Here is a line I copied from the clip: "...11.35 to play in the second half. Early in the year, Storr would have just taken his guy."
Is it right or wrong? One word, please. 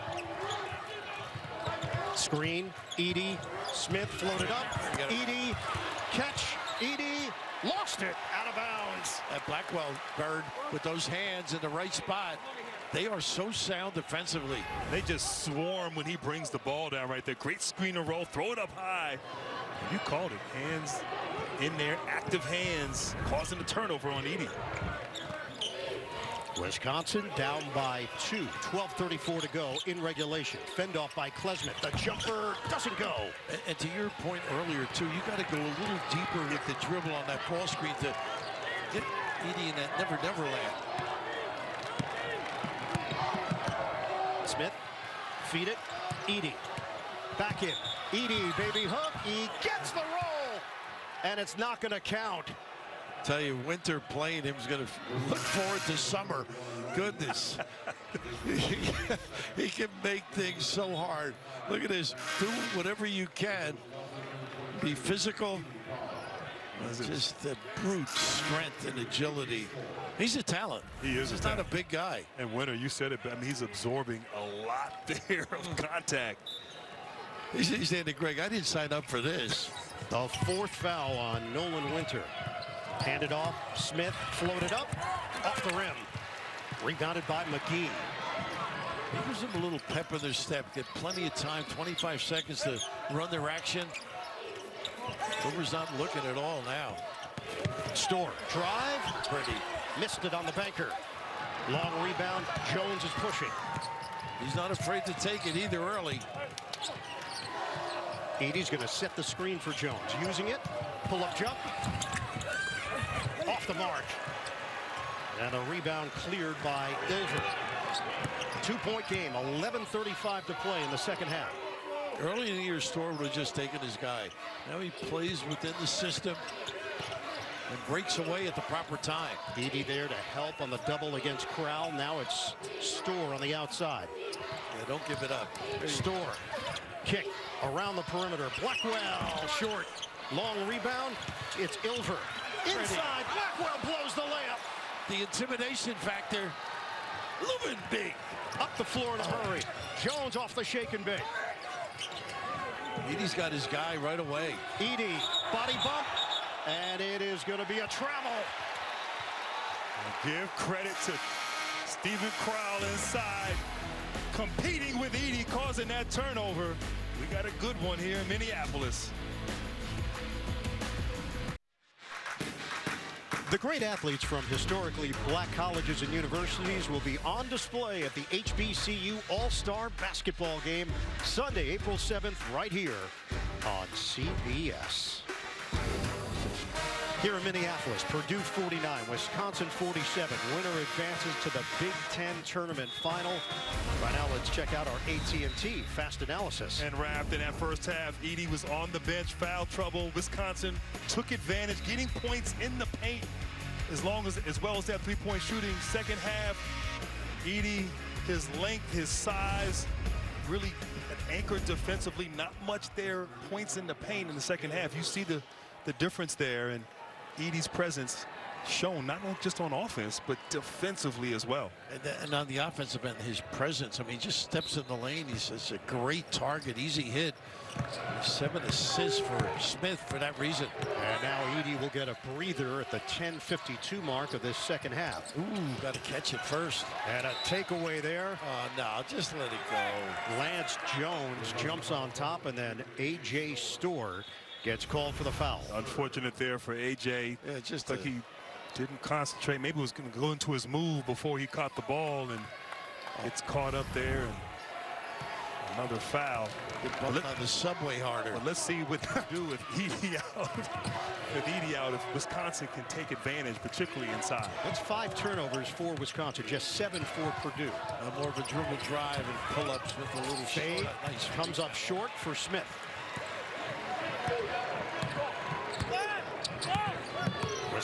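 right.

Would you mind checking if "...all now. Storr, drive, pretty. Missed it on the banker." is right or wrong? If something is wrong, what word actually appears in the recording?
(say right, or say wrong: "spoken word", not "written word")
right.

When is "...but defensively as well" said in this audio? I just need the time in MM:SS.
03:40.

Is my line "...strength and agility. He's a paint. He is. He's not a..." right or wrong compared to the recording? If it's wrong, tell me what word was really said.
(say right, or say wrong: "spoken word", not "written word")
wrong: "talent", not "paint".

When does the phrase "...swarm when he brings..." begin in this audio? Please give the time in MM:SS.
00:15.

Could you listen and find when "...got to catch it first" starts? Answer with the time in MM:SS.
03:55.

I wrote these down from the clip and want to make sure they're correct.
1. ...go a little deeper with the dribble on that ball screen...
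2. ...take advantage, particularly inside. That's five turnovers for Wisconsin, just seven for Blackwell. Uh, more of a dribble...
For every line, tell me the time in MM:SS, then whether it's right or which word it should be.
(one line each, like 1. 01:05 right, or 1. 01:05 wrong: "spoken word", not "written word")
1. 00:35 right
2. 04:22 wrong: "Purdue", not "Blackwell".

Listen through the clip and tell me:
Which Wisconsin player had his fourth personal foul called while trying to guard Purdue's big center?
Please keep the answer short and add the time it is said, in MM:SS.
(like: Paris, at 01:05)
Nolan Winter, at 01:21.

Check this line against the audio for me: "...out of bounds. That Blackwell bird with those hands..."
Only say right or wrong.
right.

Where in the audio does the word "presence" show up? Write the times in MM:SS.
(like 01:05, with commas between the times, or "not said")
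03:37, 03:43.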